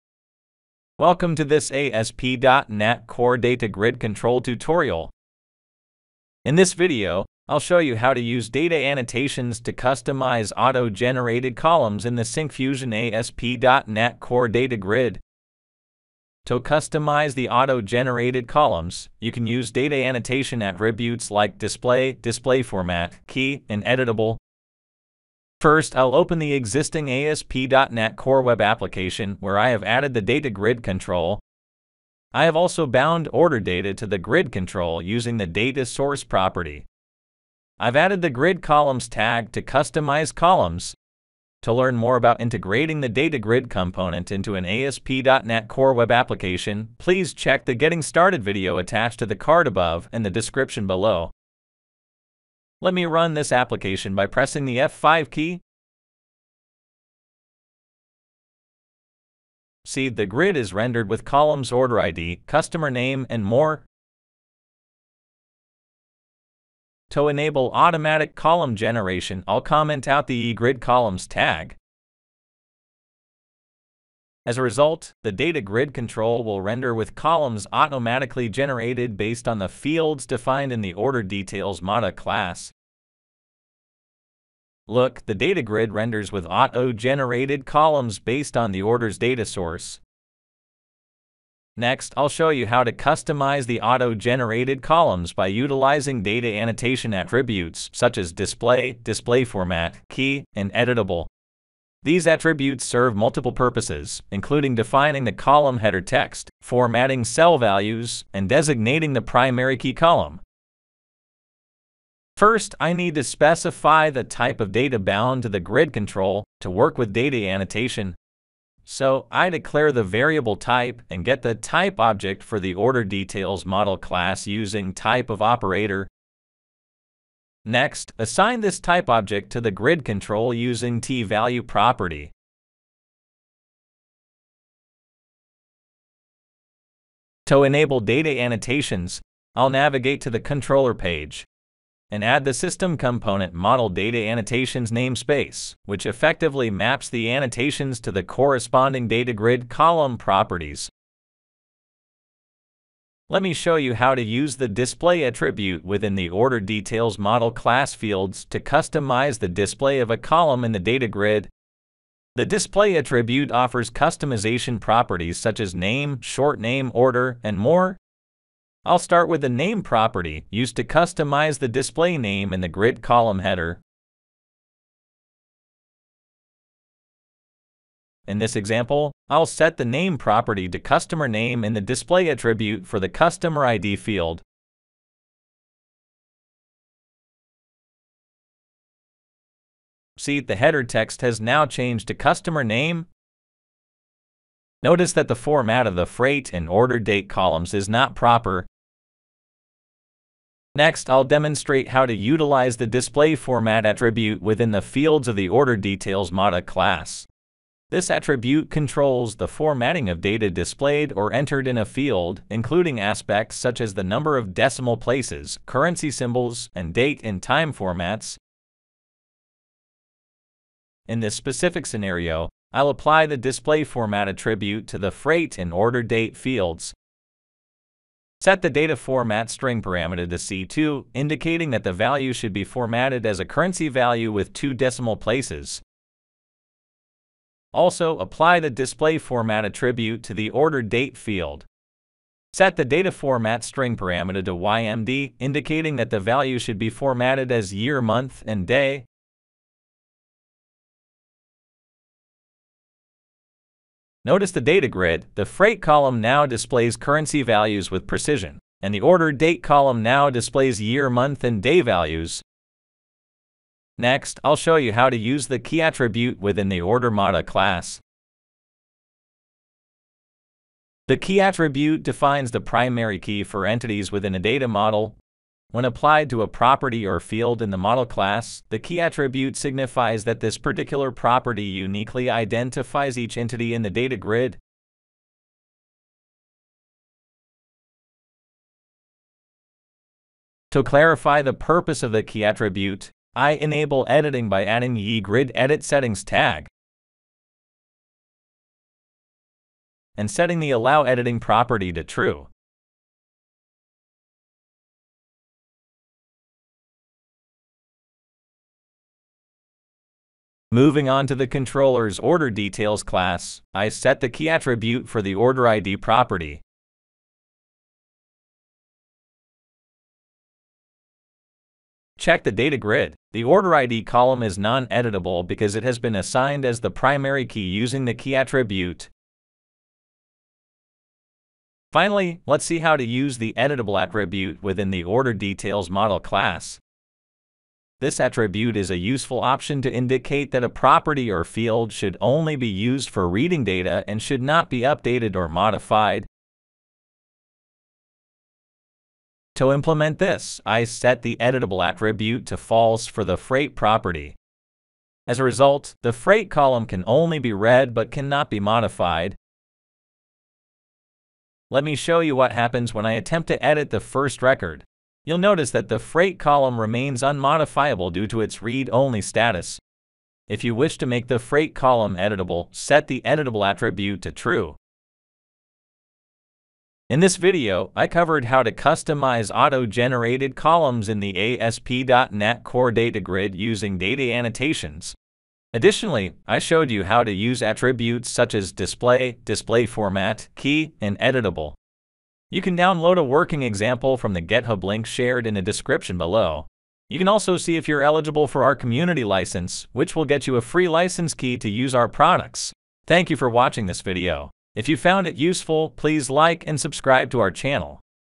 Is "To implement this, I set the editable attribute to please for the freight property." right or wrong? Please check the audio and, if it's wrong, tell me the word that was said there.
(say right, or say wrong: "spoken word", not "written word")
wrong: "false", not "please".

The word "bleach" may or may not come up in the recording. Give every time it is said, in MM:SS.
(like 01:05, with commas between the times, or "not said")
not said.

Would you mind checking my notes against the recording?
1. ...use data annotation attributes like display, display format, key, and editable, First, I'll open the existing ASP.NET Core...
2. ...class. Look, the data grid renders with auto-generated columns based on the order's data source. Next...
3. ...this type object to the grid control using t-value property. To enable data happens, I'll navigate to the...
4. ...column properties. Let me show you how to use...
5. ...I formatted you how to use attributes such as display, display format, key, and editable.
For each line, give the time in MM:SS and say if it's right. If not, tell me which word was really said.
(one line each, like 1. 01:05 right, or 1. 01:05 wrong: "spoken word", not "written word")
1. 00:19 right
2. 01:22 right
3. 02:08 wrong: "annotations", not "happens"
4. 02:29 right
5. 06:26 wrong: "showed", not "formatted".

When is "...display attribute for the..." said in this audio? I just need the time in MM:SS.
03:01.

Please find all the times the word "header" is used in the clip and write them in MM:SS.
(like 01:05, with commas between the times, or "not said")
01:45, 02:53, 03:10.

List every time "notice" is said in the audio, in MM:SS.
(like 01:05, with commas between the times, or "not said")
03:14, 04:14, 06:05.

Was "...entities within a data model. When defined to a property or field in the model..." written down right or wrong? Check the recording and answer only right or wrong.
wrong.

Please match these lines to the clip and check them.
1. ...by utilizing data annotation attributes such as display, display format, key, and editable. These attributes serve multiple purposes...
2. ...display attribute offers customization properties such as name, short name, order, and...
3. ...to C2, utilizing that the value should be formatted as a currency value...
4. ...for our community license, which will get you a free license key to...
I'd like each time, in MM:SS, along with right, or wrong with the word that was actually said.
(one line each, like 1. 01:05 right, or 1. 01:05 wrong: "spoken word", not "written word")
1. 01:35 right
2. 02:42 right
3. 03:50 wrong: "indicating", not "utilizing"
4. 06:38 right.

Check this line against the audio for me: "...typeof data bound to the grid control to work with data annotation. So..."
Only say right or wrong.
right.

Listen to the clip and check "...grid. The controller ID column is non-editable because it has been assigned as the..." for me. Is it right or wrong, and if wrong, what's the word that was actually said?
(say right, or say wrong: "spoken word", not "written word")
wrong: "order", not "controller".